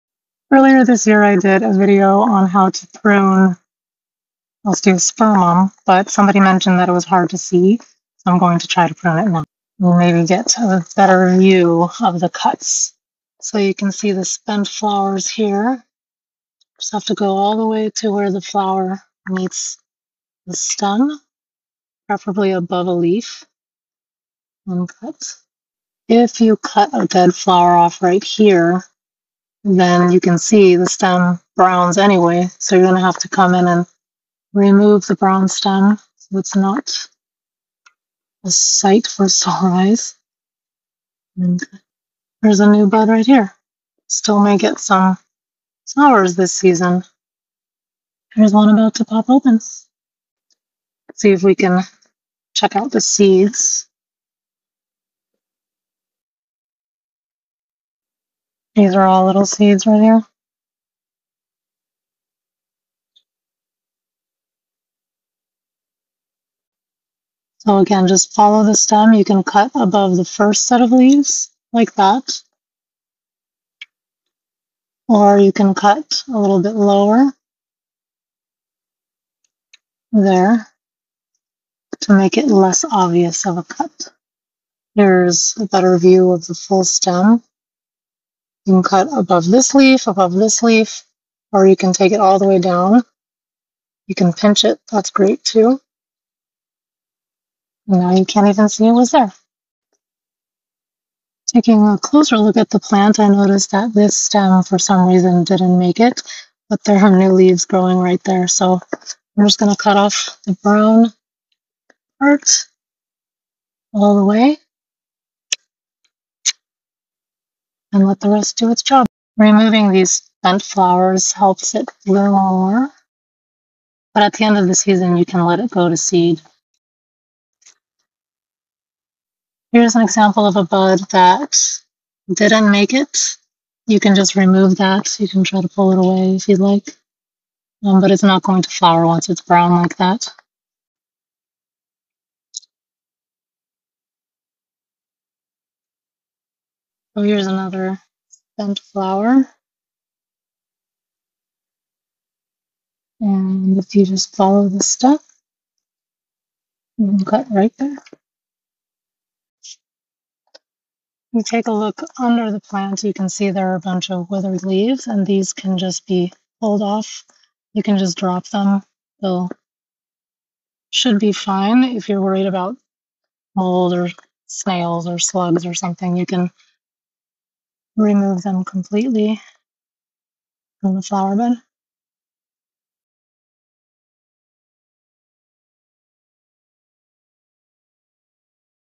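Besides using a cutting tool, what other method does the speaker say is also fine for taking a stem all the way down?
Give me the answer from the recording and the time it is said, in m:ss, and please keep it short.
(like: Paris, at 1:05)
Pinch it, at 1:34.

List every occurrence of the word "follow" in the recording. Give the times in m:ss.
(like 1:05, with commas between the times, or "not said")
1:08, 2:34.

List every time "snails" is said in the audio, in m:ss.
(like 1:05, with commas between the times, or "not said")
2:54.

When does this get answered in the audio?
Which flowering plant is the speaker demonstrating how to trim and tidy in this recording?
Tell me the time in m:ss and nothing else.
0:04.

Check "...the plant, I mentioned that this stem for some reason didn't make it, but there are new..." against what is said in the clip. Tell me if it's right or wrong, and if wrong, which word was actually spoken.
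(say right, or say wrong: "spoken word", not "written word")
wrong: "noticed", not "mentioned".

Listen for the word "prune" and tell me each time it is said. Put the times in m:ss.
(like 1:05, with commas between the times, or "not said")
0:02, 0:08.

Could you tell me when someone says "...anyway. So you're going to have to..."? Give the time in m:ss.
0:31.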